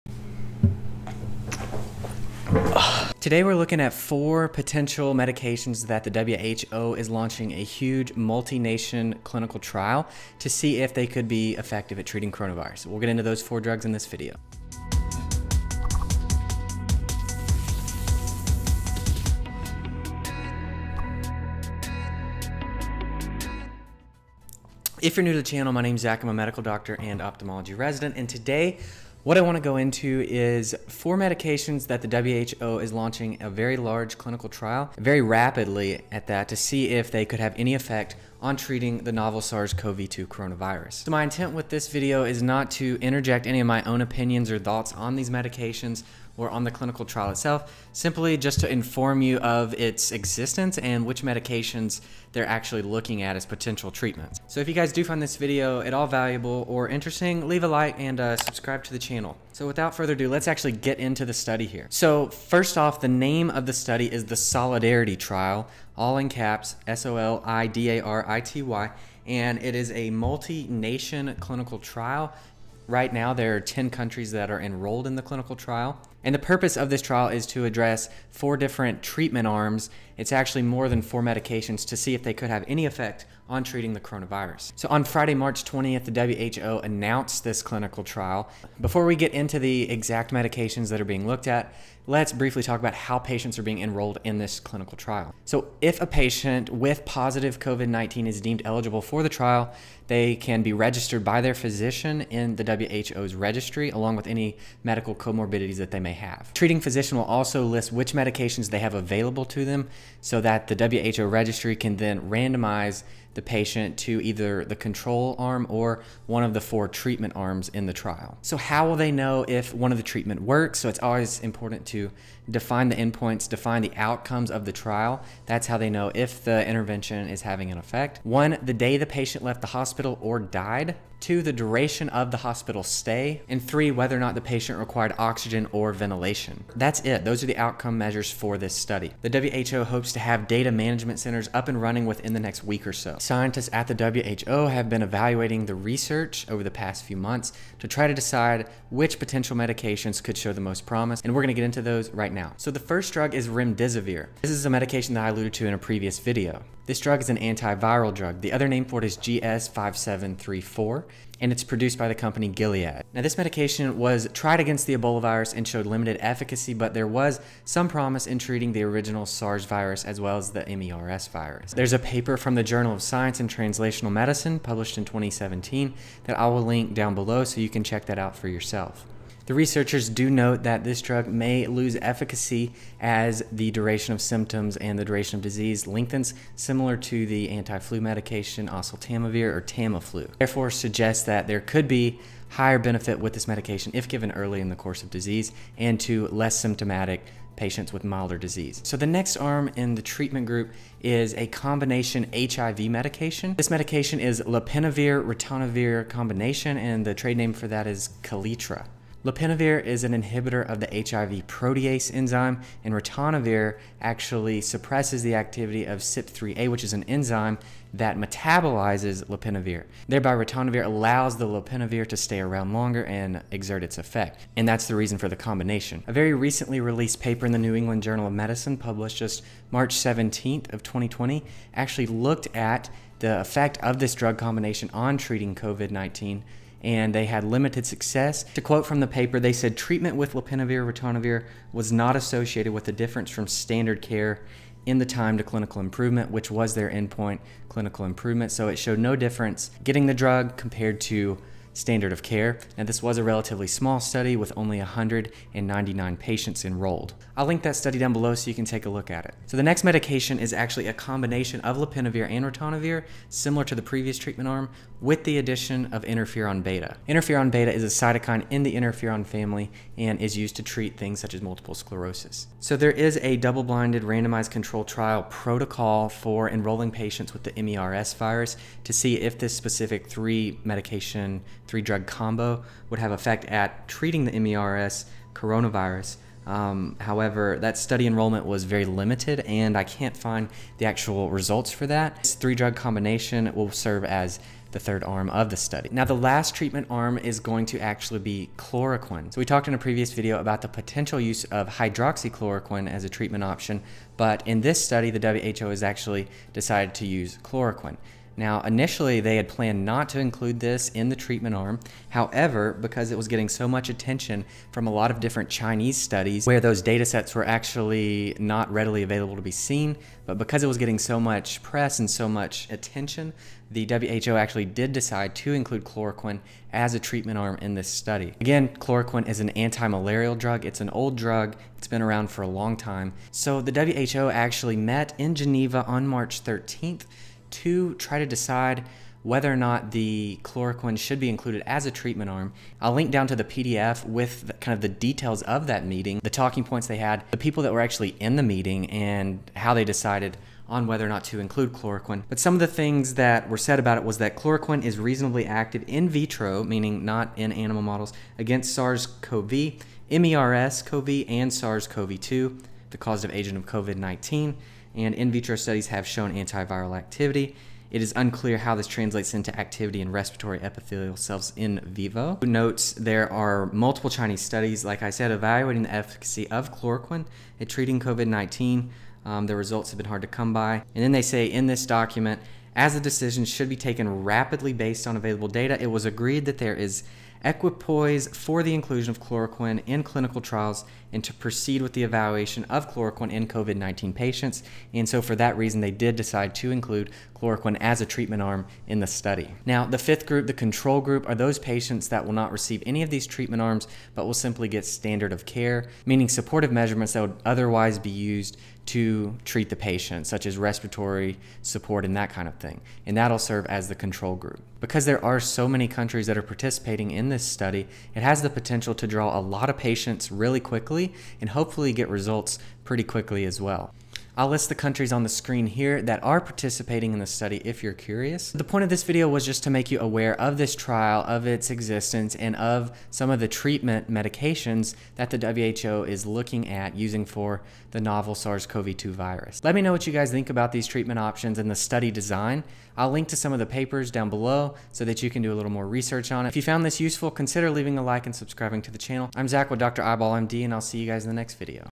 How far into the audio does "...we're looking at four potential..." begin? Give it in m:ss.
0:03.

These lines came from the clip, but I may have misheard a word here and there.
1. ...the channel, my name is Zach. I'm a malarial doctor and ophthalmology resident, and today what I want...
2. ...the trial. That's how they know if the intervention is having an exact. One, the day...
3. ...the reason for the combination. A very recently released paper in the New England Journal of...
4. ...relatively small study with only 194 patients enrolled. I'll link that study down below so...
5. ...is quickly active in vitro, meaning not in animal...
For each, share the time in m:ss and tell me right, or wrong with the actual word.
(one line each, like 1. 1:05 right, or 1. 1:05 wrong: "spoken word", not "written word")
1. 0:25 wrong: "medical", not "malarial"
2. 2:04 wrong: "effect", not "exact"
3. 3:44 right
4. 4:13 wrong: "199", not "194"
5. 5:54 wrong: "reasonably", not "quickly".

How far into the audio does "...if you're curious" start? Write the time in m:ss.
7:07.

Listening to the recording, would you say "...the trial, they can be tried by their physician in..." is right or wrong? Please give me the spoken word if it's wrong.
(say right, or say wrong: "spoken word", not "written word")
wrong: "registered", not "tried".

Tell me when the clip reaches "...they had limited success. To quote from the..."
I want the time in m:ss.
3:57.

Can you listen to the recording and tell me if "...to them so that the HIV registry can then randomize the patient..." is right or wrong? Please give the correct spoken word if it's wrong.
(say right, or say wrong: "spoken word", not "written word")
wrong: "WHO", not "HIV".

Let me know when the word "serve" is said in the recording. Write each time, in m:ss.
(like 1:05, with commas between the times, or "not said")
4:53, 6:53.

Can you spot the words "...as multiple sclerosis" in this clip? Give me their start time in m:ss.
4:31.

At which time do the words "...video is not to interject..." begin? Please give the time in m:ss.
0:41.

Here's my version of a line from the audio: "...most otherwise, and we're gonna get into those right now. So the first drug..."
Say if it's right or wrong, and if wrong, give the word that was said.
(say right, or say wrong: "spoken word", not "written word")
wrong: "promise", not "otherwise".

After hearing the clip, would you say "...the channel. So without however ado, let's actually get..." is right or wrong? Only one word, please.
wrong.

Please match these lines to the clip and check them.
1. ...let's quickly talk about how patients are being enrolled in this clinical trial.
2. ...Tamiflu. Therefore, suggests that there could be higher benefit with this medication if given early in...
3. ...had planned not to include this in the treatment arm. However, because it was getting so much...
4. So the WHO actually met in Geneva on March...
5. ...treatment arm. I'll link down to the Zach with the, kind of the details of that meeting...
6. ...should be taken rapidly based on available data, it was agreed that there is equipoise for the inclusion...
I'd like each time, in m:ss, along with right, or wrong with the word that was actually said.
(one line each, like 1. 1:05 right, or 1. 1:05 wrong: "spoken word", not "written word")
1. 1:32 wrong: "briefly", not "quickly"
2. 3:09 right
3. 5:09 right
4. 5:33 right
5. 5:41 wrong: "PDF", not "Zach"
6. 6:23 right.